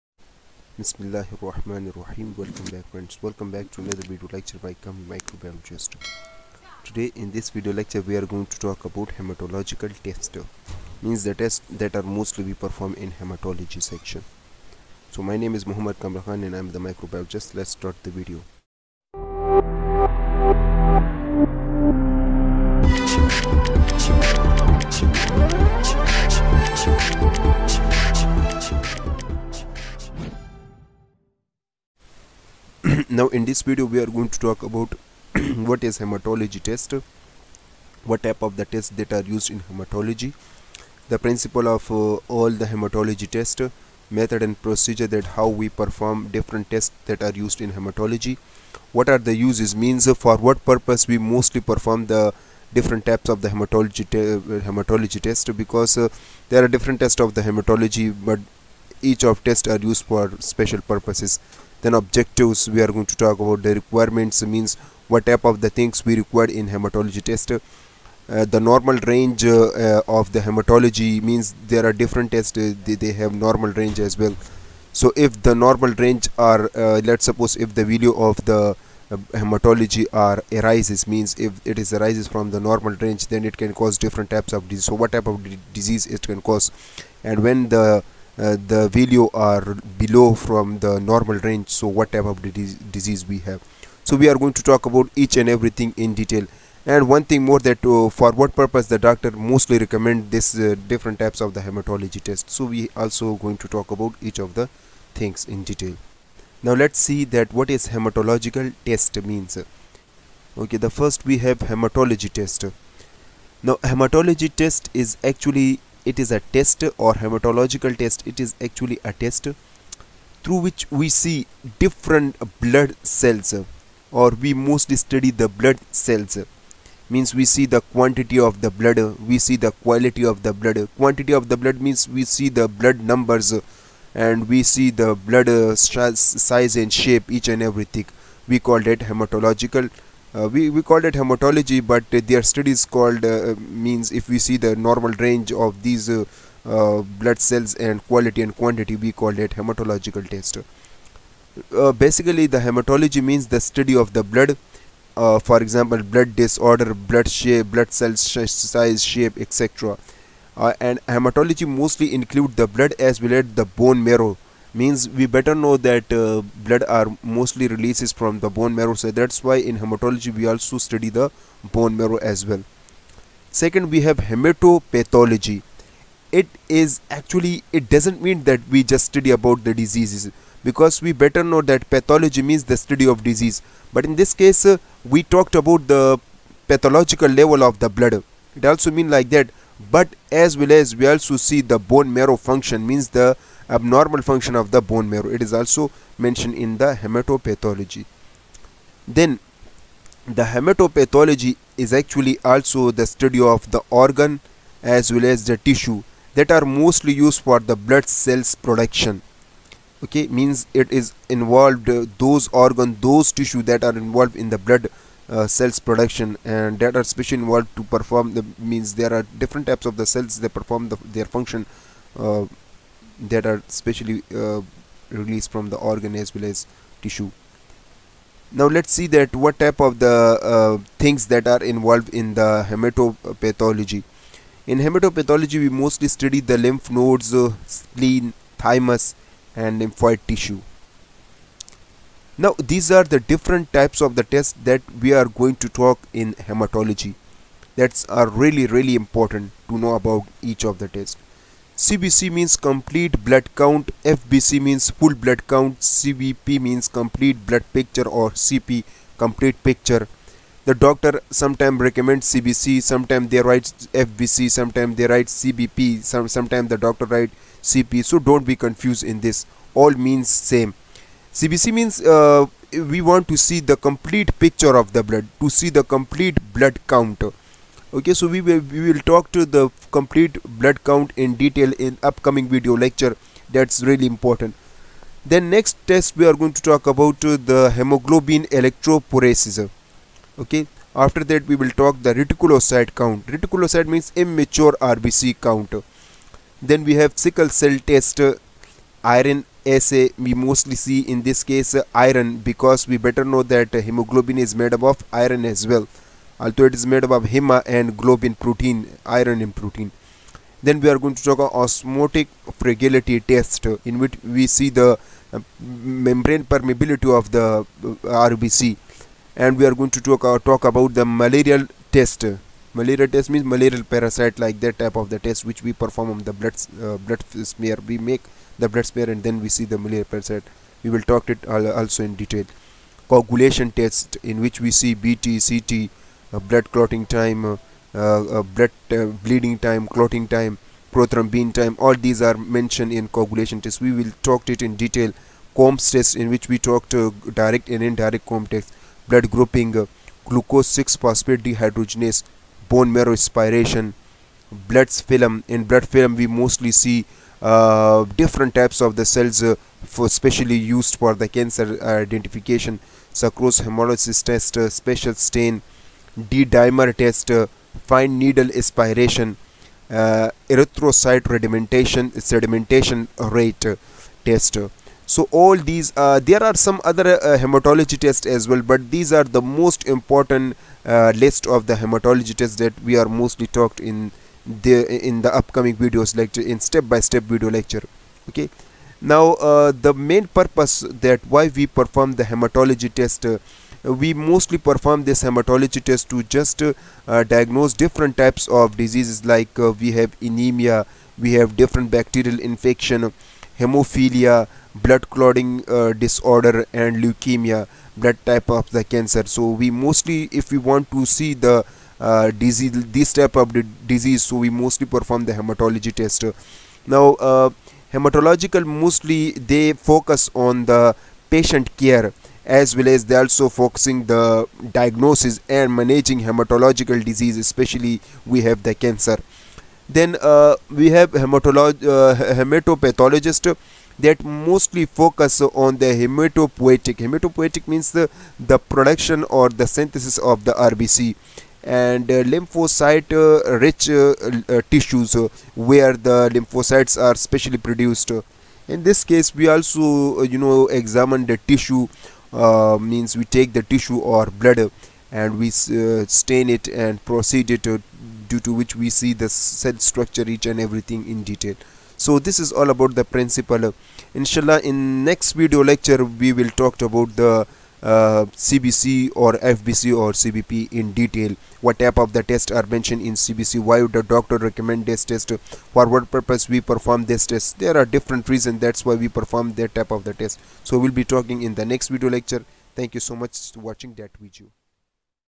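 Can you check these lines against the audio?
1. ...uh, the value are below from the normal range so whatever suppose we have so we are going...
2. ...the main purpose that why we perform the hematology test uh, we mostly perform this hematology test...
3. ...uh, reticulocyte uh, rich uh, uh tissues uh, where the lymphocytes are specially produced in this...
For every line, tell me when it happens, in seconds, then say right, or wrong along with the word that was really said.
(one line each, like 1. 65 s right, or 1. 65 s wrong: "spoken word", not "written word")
1. 88 s wrong: "disease", not "suppose"
2. 389 s right
3. 442 s wrong: "lymphocyte", not "reticulocyte".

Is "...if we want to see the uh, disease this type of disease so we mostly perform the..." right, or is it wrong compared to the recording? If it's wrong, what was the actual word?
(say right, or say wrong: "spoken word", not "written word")
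right.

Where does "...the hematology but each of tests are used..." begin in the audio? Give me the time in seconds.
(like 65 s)
57 s.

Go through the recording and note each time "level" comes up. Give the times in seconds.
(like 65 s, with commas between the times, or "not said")
187 s.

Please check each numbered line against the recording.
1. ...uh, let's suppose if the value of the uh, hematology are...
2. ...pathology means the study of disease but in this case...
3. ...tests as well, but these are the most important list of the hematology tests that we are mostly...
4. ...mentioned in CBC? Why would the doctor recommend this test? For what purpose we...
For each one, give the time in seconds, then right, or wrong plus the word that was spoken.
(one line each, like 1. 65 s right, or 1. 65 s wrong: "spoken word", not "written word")
1. 76 s right
2. 181 s right
3. 377 s right
4. 472 s right.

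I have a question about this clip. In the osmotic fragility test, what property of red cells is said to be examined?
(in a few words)
membrane permeability.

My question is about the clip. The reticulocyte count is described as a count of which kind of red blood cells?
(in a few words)
immature RBC.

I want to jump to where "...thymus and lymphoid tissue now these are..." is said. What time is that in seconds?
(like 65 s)
238 s.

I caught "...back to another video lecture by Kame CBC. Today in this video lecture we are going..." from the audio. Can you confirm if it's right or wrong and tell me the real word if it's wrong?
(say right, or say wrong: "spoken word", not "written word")
wrong: "Microbiologist", not "CBC".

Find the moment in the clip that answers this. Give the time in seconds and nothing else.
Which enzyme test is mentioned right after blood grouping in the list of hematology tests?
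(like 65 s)
350 s.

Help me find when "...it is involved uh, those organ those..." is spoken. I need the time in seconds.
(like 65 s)
210 s.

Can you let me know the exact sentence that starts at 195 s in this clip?
It is also mentioned in the hematopathology.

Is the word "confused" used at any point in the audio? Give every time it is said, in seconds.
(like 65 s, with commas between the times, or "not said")
268 s.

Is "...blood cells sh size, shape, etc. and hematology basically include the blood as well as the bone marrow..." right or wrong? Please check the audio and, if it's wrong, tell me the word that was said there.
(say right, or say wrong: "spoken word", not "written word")
wrong: "mostly", not "basically".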